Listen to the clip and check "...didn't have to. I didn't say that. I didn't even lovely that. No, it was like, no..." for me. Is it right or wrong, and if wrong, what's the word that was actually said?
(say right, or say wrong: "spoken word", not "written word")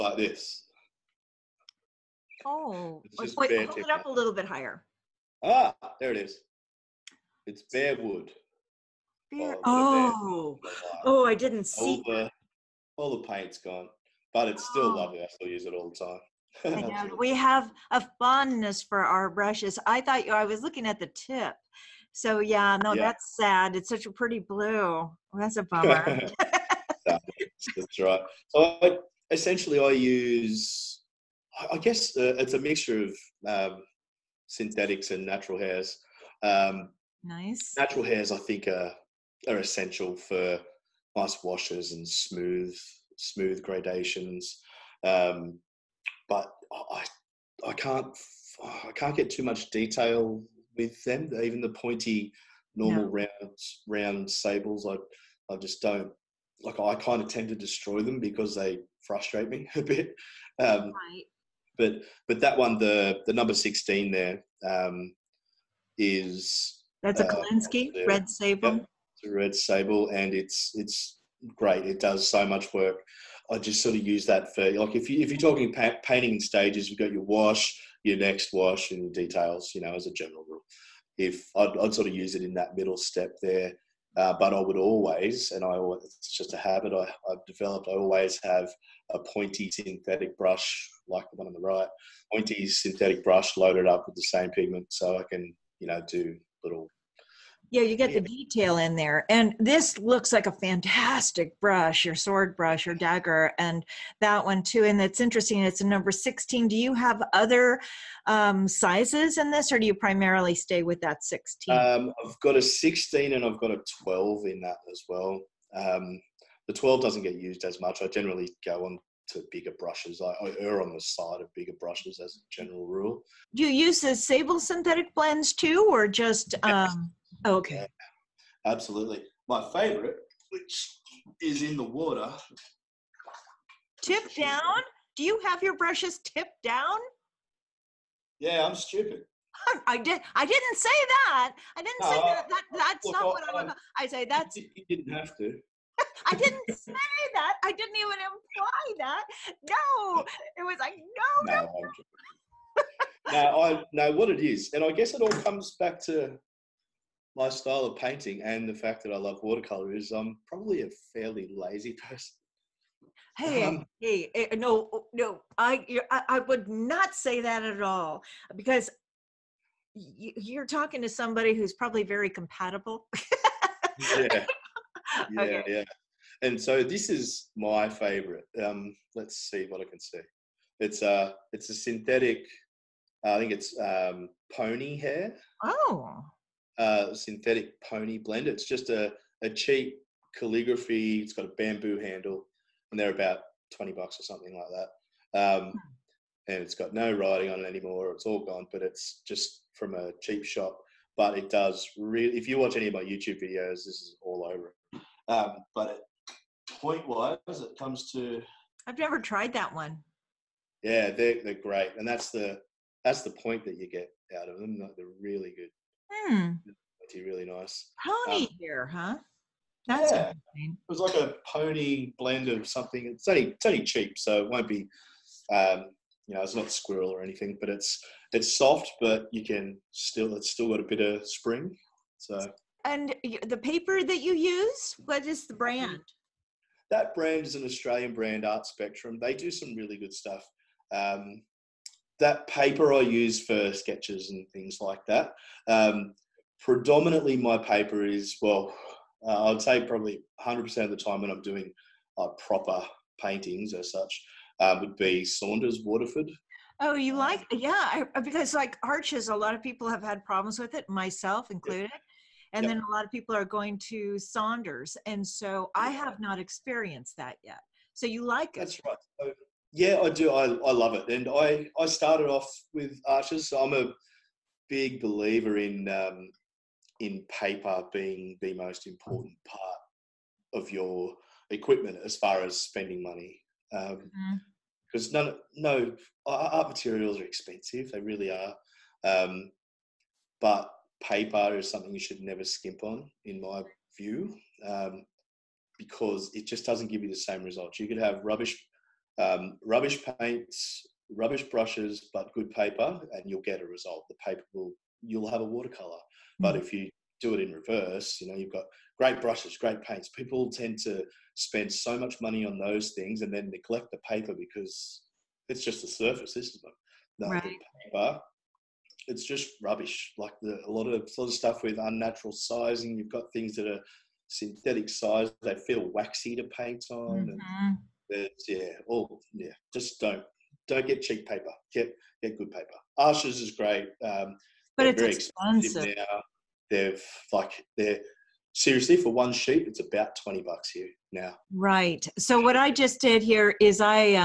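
wrong: "imply", not "lovely".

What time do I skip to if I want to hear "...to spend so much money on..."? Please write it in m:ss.
5:10.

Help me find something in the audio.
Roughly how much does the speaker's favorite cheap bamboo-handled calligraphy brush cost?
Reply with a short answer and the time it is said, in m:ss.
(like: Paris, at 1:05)
about $20, at 3:13.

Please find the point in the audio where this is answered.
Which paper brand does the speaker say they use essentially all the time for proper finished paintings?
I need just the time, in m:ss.
4:15.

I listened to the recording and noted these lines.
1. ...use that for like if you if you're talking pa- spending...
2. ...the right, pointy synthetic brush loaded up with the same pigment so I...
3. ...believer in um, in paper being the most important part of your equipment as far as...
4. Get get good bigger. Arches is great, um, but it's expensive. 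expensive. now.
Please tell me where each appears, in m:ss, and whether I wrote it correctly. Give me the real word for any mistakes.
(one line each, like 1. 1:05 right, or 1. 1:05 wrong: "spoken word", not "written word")
1. 1:14 wrong: "painting", not "spending"
2. 1:31 right
3. 4:35 right
4. 5:31 wrong: "paper", not "bigger".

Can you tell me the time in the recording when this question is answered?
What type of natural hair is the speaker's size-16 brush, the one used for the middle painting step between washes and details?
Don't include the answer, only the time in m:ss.
1:07.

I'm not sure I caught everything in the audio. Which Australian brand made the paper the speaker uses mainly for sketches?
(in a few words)
Art Spectrum.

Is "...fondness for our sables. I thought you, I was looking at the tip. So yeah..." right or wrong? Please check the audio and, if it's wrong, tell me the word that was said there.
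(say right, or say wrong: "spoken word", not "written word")
wrong: "brushes", not "sables".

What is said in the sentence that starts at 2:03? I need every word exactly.
Do you use the sable synthetic blends too, or just?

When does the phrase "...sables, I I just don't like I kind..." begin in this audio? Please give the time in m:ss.
0:54.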